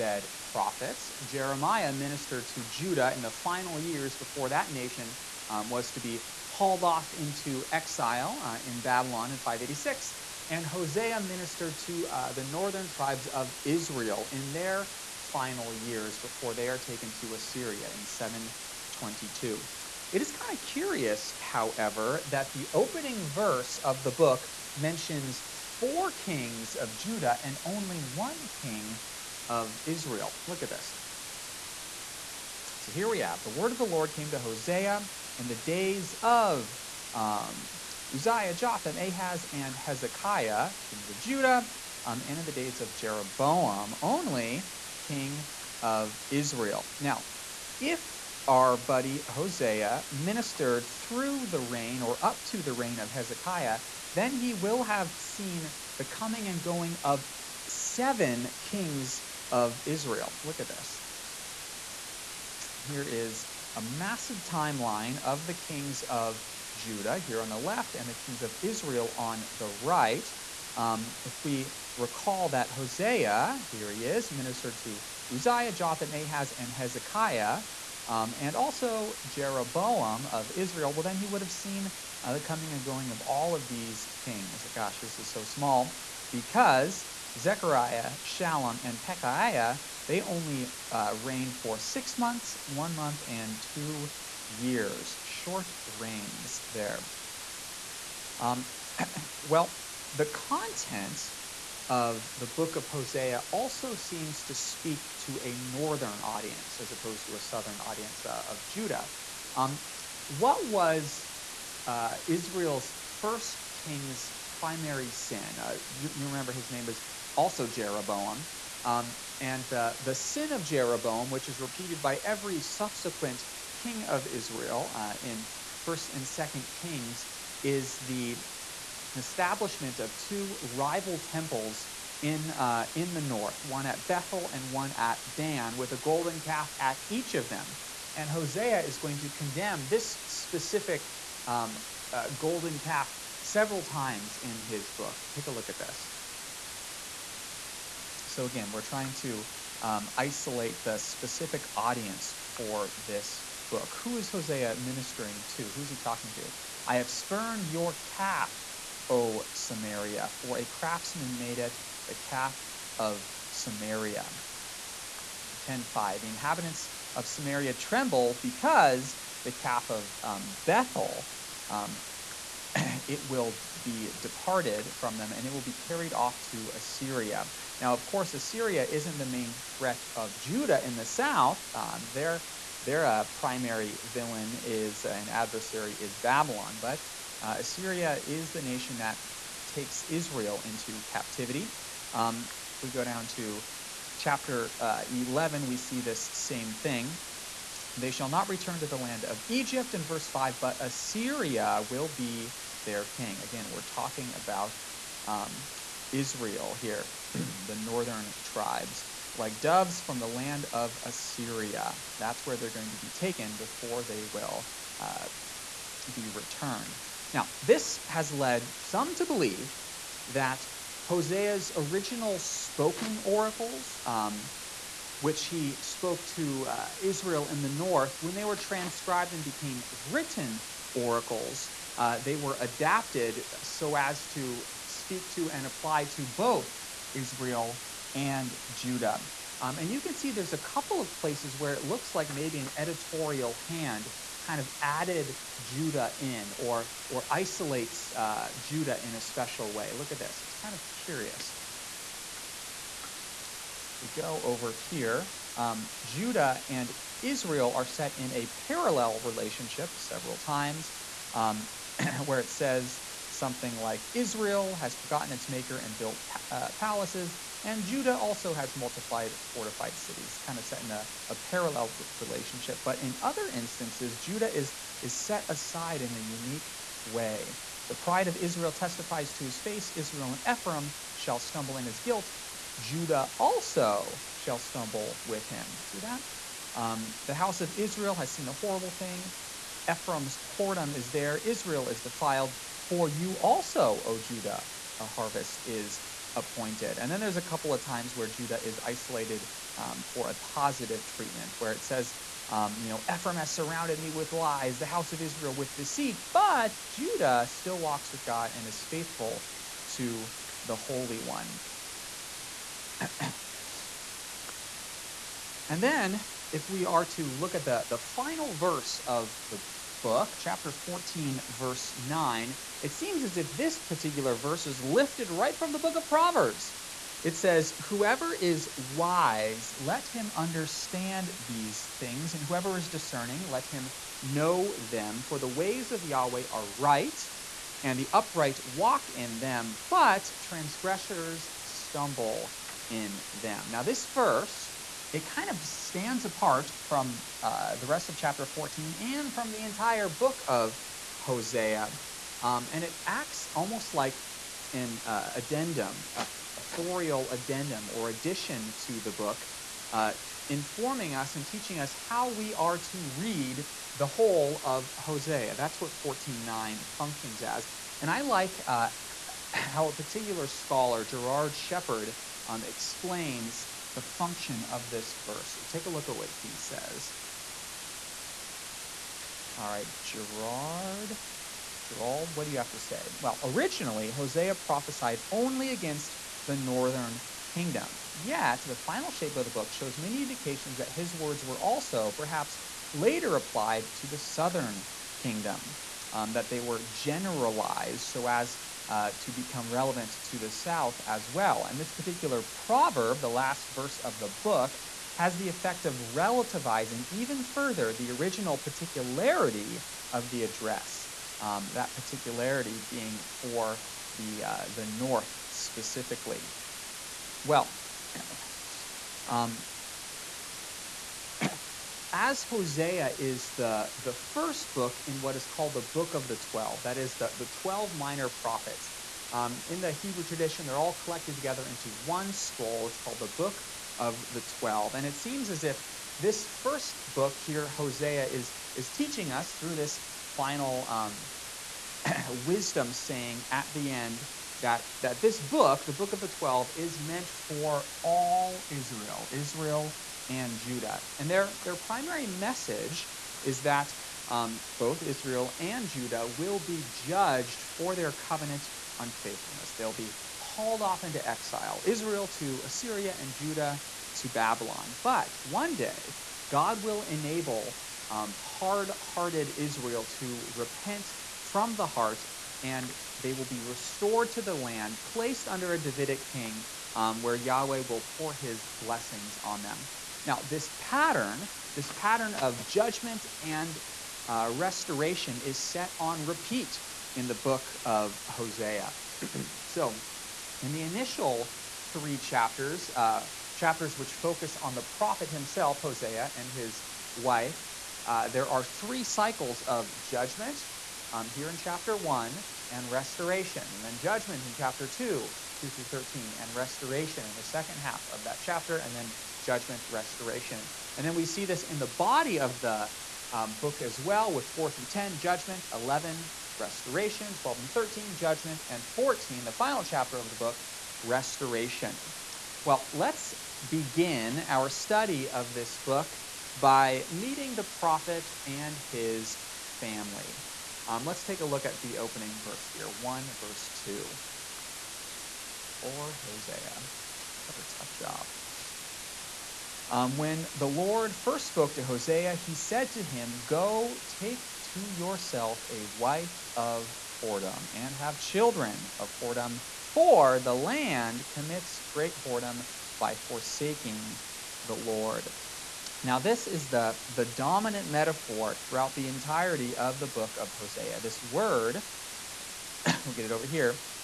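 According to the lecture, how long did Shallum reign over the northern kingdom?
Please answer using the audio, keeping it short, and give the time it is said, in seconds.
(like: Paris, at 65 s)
1 month, at 92 s.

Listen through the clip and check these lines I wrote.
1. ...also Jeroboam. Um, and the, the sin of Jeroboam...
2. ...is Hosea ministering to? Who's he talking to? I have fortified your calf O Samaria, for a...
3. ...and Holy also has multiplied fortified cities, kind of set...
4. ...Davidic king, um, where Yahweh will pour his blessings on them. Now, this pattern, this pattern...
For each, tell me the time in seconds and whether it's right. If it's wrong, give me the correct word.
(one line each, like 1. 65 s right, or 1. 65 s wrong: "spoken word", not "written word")
1. 117 s right
2. 154 s wrong: "spurned", not "fortified"
3. 267 s wrong: "Judah", not "Holy"
4. 475 s right.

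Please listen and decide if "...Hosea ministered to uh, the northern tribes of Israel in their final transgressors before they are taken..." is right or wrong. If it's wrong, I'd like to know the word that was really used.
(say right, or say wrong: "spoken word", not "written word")
wrong: "years", not "transgressors".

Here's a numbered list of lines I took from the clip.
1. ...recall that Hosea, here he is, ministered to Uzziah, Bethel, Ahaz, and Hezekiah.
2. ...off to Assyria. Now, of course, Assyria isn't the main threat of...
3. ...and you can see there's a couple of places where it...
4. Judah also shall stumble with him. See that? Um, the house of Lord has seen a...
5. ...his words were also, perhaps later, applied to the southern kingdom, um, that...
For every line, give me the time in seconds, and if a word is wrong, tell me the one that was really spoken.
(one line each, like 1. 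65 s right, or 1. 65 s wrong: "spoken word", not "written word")
1. 71 s wrong: "Jotham", not "Bethel"
2. 176 s right
3. 239 s right
4. 282 s wrong: "Israel", not "Lord"
5. 390 s right.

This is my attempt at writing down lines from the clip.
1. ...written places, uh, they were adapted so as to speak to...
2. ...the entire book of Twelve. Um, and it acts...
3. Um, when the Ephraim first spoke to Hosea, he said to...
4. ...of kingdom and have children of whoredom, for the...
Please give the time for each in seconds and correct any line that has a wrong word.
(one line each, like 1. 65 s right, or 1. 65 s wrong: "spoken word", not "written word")
1. 230 s wrong: "oracles", not "places"
2. 349 s wrong: "Hosea", not "Twelve"
3. 539 s wrong: "Lord", not "Ephraim"
4. 546 s wrong: "whoredom", not "kingdom".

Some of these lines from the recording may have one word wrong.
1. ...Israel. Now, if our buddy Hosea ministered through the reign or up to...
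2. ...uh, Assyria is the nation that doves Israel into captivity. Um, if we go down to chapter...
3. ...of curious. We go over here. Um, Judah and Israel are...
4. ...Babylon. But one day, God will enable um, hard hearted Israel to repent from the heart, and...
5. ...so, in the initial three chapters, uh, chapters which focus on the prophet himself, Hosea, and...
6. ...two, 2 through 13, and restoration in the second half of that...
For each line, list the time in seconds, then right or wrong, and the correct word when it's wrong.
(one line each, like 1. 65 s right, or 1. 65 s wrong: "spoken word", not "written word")
1. 46 s right
2. 187 s wrong: "takes", not "doves"
3. 250 s right
4. 464 s right
5. 489 s right
6. 504 s right.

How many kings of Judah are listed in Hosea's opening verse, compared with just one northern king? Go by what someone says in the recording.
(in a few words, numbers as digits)
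4.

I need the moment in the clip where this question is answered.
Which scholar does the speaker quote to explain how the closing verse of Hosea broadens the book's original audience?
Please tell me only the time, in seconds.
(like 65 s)
371 s.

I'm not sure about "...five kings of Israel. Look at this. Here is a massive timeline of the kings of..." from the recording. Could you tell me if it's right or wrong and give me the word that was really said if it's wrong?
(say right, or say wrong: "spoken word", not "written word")
wrong: "seven", not "five".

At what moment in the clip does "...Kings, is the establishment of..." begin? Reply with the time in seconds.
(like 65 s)
126 s.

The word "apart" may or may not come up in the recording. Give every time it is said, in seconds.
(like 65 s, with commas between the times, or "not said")
346 s.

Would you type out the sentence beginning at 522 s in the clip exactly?
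Well, let's begin our study of this book by meeting the prophet and his family.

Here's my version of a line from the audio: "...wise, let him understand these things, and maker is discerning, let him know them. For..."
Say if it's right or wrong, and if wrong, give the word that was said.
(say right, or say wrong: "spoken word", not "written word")
wrong: "whoever", not "maker".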